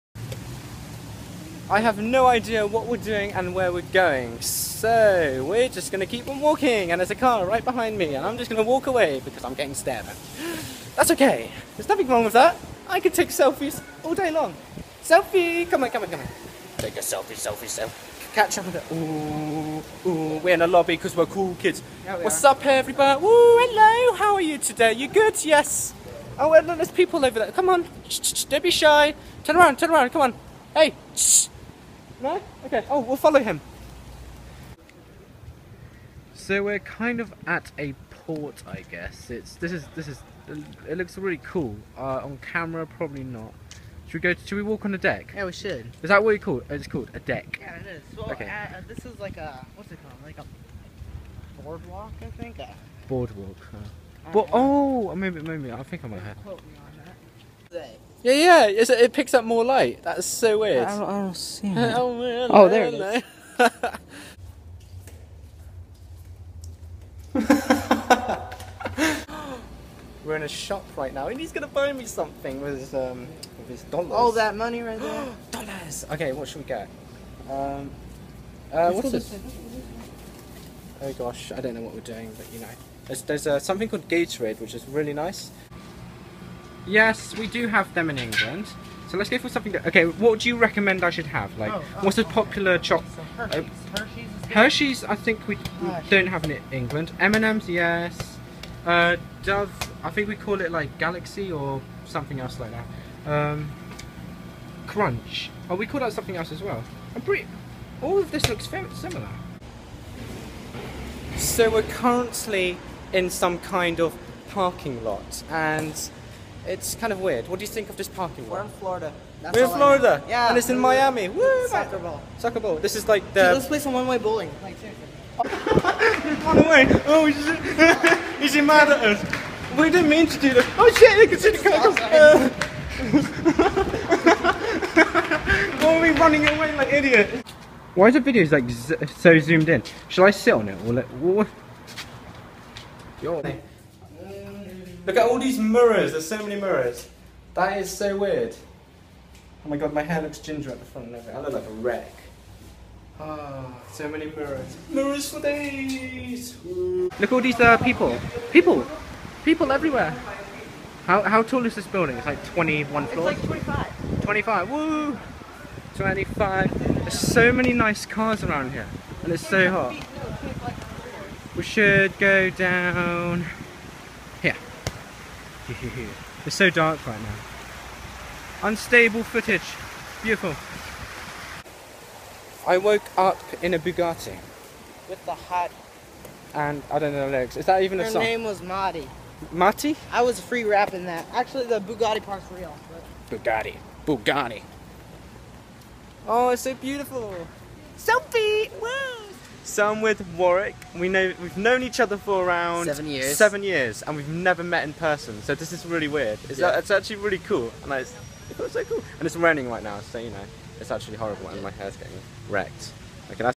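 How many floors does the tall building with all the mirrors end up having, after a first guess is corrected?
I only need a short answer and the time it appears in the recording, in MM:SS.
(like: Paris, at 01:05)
25, at 02:43.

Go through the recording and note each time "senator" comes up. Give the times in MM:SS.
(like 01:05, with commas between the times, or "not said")
not said.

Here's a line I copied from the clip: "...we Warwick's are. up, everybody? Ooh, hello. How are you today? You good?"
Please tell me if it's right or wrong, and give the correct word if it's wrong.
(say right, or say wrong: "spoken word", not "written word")
wrong: "What", not "Warwick".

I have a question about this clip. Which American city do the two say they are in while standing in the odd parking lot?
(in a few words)
Miami.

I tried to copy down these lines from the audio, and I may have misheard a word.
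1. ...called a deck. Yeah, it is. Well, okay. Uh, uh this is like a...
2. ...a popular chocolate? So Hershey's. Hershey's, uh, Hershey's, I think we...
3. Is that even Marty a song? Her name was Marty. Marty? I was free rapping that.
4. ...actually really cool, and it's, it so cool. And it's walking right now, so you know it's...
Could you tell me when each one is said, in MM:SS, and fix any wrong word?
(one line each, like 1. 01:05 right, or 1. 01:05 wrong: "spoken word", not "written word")
1. 00:46 right
2. 01:32 right
3. 03:07 wrong: "Her", not "Marty"
4. 03:26 wrong: "raining", not "walking".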